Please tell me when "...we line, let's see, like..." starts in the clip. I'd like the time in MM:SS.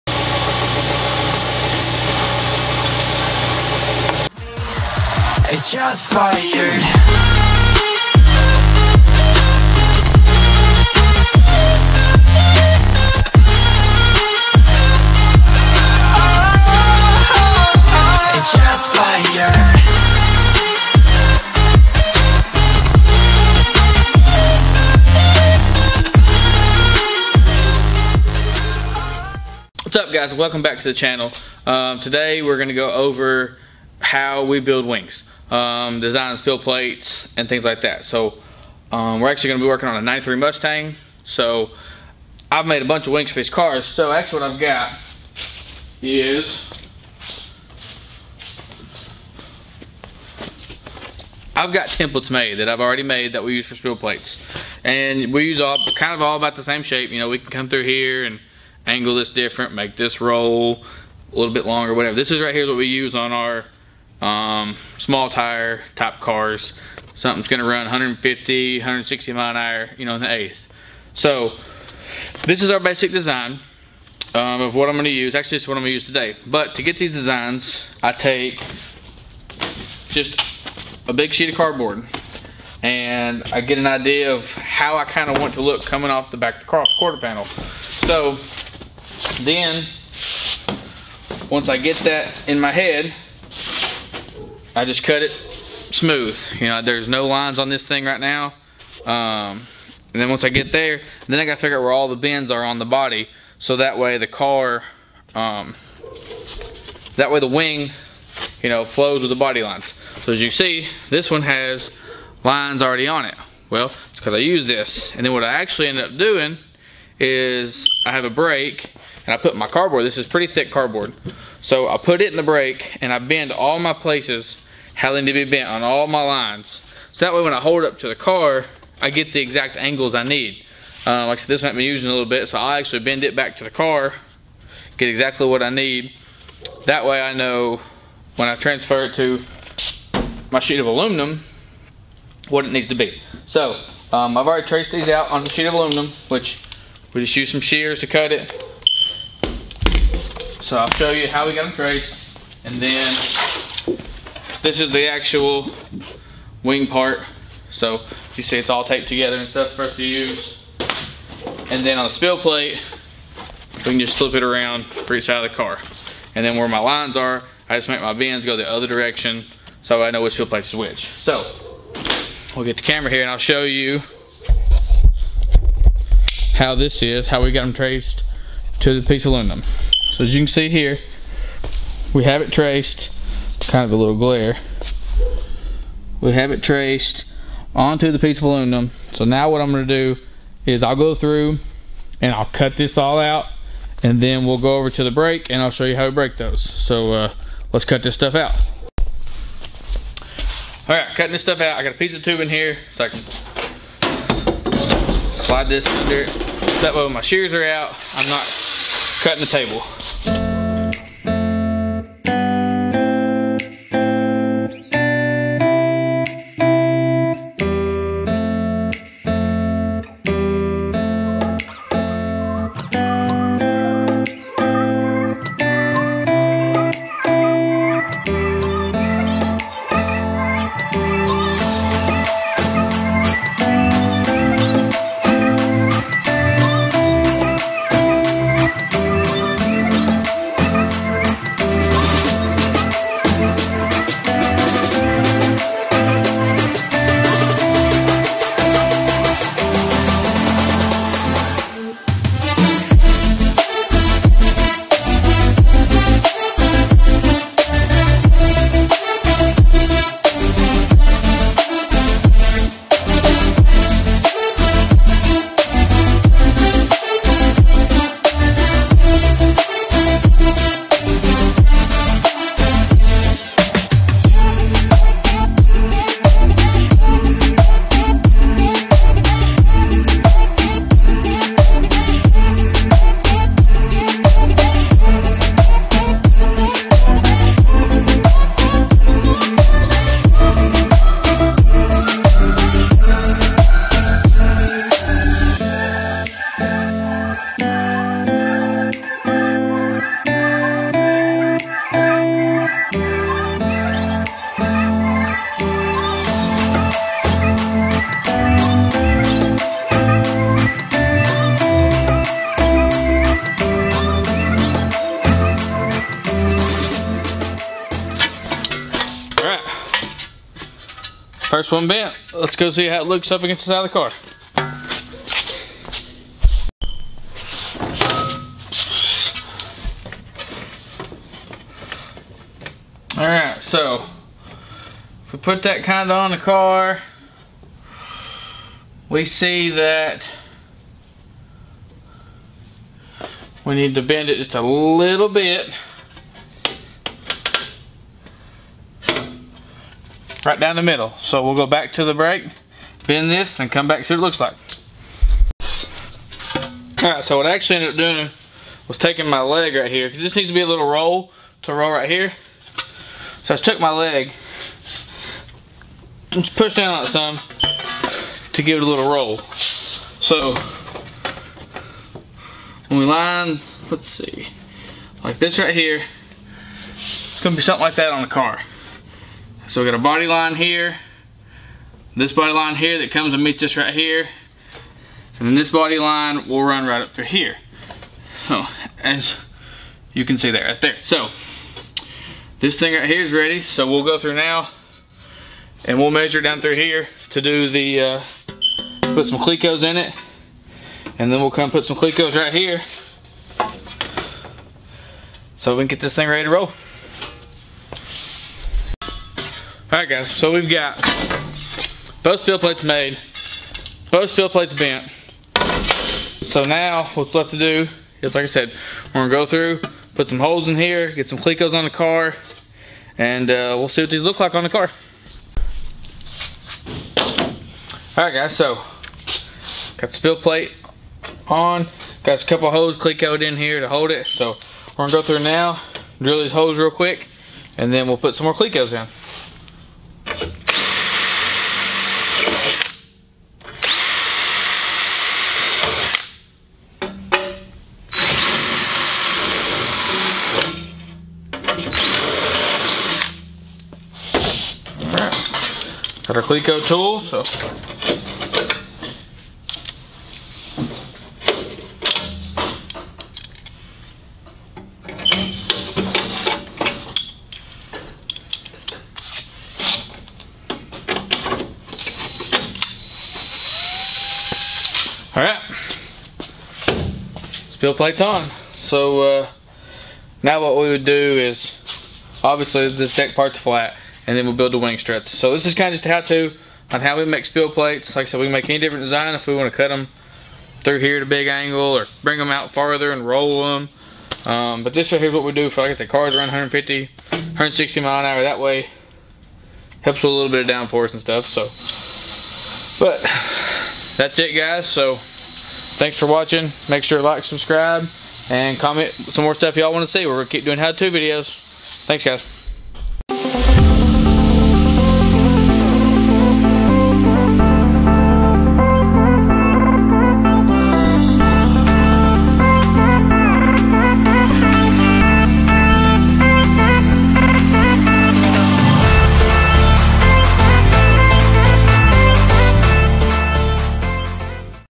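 06:12.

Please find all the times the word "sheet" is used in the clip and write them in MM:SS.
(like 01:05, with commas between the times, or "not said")
01:21, 02:20, 02:25.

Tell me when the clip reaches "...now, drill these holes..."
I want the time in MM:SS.
07:15.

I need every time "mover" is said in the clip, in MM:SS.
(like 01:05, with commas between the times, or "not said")
not said.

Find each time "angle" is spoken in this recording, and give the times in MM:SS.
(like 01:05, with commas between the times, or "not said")
00:58, 02:09, 08:11.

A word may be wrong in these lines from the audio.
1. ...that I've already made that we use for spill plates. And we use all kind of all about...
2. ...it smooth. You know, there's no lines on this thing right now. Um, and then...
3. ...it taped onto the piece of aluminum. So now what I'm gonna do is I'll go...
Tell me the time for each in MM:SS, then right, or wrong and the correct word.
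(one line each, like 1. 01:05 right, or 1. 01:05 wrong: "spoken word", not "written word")
1. 00:52 right
2. 01:35 right
3. 03:06 wrong: "traced", not "taped".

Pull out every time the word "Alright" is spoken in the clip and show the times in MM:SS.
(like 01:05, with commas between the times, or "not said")
05:33, 06:49, 07:08.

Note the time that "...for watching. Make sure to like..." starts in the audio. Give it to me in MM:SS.
08:26.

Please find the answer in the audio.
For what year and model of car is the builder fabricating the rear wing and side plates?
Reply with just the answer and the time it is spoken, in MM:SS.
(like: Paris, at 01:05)
93 Mustang, at 00:40.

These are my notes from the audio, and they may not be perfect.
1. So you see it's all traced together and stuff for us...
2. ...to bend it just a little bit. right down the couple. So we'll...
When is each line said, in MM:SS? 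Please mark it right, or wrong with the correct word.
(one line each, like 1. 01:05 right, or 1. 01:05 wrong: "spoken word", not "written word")
1. 02:37 wrong: "taped", not "traced"
2. 05:43 wrong: "middle", not "couple".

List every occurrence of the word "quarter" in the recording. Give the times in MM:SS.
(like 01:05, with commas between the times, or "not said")
01:26.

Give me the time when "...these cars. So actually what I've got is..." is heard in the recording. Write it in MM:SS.
00:43.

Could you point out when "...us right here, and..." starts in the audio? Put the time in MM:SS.
06:23.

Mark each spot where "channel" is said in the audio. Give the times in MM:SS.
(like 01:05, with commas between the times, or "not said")
00:30.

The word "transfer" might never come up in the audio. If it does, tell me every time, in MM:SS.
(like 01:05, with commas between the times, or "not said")
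02:18.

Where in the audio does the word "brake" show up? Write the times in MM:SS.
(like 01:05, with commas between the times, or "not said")
01:58, 02:02, 03:15, 05:52.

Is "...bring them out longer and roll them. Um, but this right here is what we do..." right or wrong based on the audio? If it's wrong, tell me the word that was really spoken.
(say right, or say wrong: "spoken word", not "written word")
wrong: "farther", not "longer".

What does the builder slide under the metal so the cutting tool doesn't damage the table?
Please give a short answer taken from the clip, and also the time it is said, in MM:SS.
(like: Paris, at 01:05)
piece of tubing, at 03:21.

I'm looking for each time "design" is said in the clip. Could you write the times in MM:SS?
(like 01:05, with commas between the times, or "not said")
01:13, 01:17, 08:09.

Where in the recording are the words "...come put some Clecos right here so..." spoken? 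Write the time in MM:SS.
06:41.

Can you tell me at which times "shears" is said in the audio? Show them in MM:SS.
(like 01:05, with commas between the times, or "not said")
02:27, 03:27.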